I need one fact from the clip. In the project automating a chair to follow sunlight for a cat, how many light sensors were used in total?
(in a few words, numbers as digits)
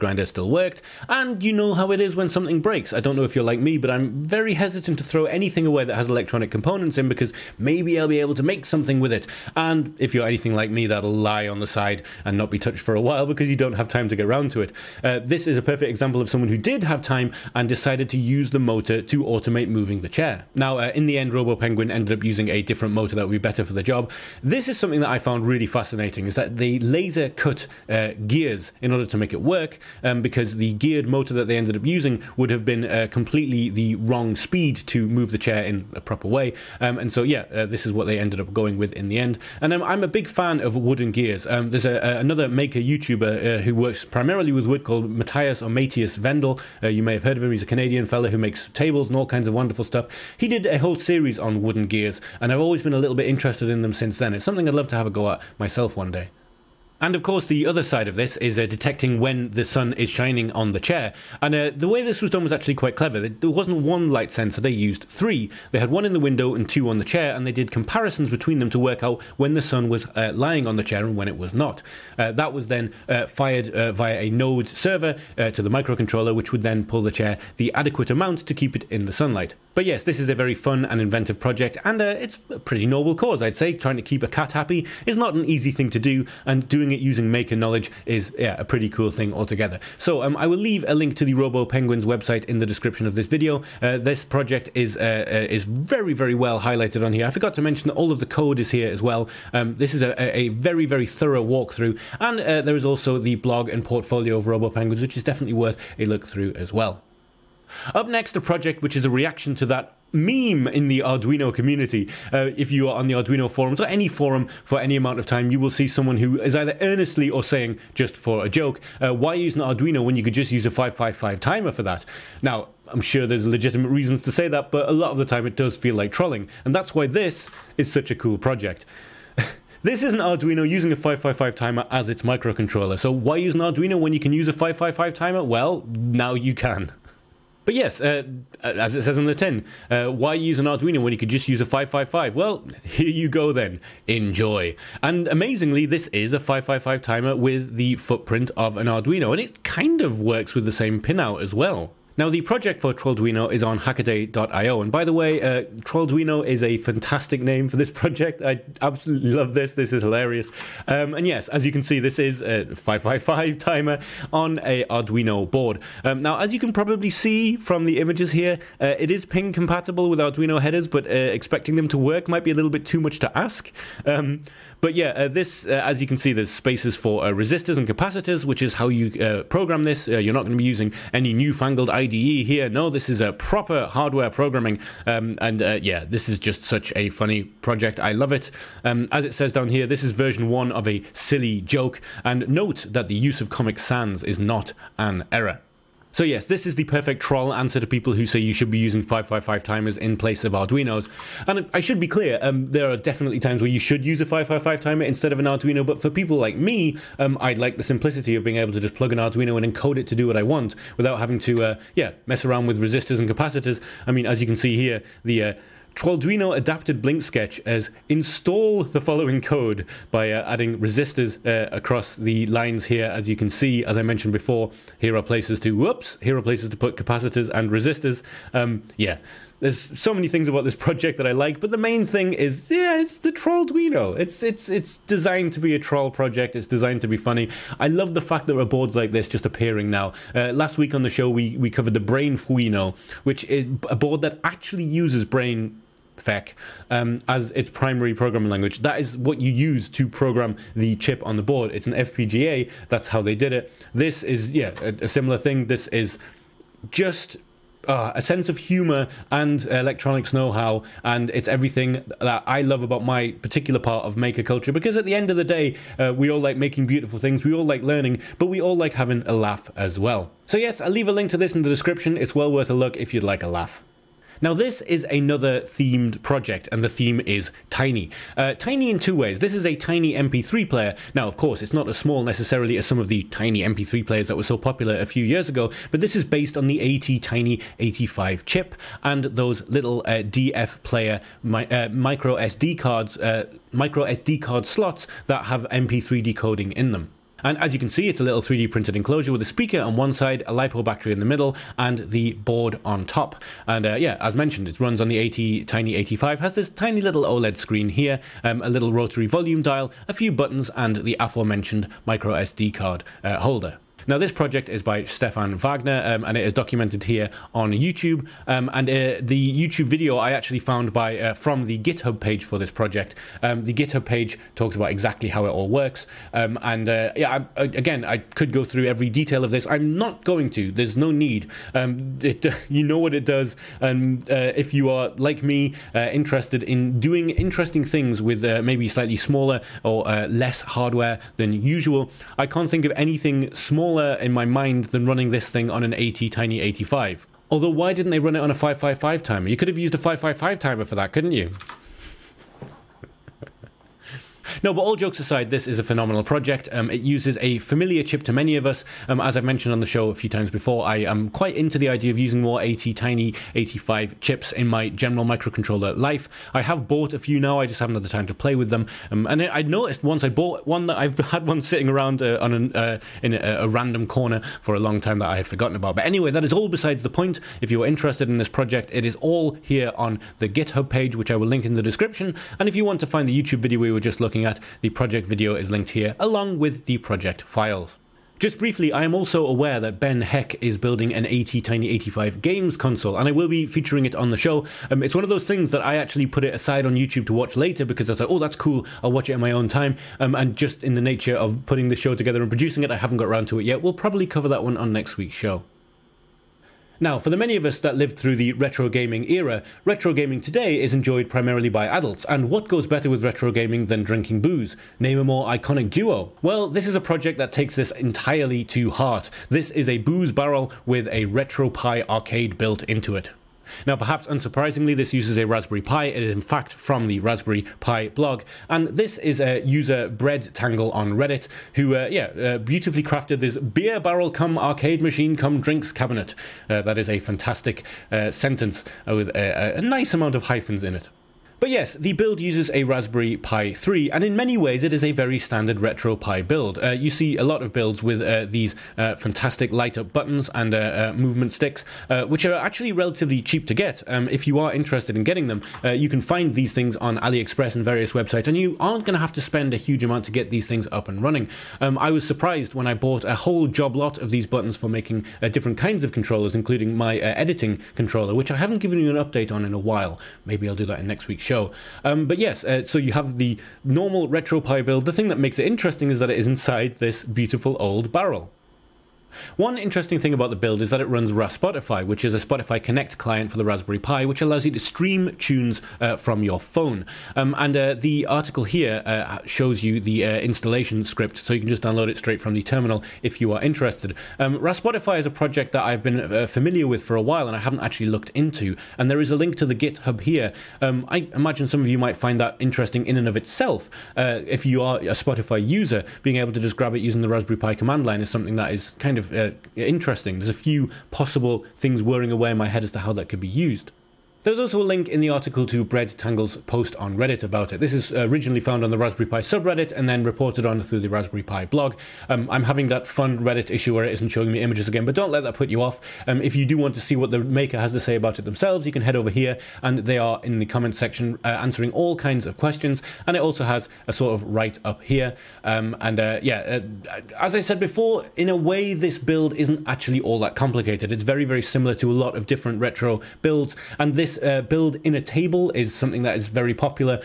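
3.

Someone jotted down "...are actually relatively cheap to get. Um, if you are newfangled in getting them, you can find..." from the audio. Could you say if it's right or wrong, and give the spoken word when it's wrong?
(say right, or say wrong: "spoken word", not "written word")
wrong: "interested", not "newfangled".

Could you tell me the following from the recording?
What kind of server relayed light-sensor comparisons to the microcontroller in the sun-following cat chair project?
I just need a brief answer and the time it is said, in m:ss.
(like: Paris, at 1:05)
node server, at 1:14.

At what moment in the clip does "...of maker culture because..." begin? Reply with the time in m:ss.
4:24.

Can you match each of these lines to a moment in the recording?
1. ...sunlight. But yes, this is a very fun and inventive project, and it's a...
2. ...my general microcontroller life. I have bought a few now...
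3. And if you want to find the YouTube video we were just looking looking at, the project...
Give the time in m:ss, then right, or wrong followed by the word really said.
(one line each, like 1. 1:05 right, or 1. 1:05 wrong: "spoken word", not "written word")
1. 1:19 right
2. 6:04 right
3. 6:22 right.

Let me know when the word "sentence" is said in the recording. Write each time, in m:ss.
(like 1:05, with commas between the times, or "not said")
7:18.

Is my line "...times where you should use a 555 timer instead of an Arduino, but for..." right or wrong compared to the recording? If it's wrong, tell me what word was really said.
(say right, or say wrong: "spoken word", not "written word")
right.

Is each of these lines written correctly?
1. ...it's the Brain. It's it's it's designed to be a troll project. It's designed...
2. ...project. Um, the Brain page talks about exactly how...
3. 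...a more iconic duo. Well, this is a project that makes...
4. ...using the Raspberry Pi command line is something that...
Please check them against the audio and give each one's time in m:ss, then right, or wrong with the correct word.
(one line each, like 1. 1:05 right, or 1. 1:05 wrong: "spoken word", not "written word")
1. 3:52 wrong: "Trollduino", not "Brain"
2. 5:22 wrong: "GitHub", not "Brain"
3. 6:55 wrong: "takes", not "makes"
4. 8:26 right.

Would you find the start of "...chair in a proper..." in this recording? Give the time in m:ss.
0:35.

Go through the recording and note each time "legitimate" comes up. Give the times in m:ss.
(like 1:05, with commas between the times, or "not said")
2:03.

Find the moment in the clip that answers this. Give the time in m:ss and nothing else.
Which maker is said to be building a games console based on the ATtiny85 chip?
6:29.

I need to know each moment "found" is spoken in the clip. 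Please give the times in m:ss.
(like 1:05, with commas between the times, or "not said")
0:25, 5:20, 8:38.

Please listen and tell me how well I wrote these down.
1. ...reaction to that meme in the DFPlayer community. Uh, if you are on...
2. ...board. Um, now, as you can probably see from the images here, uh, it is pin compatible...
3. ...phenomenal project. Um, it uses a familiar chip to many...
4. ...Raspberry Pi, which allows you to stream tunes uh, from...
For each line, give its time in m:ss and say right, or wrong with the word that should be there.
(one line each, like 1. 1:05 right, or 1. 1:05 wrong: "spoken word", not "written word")
1. 1:49 wrong: "Arduino", not "DFPlayer"
2. 2:45 right
3. 5:55 right
4. 8:03 right.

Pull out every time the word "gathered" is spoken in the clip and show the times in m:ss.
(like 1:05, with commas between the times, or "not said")
not said.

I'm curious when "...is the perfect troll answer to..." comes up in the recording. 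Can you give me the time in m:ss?
3:16.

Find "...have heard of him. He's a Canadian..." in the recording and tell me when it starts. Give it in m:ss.
0:47.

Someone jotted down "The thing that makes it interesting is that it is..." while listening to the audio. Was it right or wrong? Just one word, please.
right.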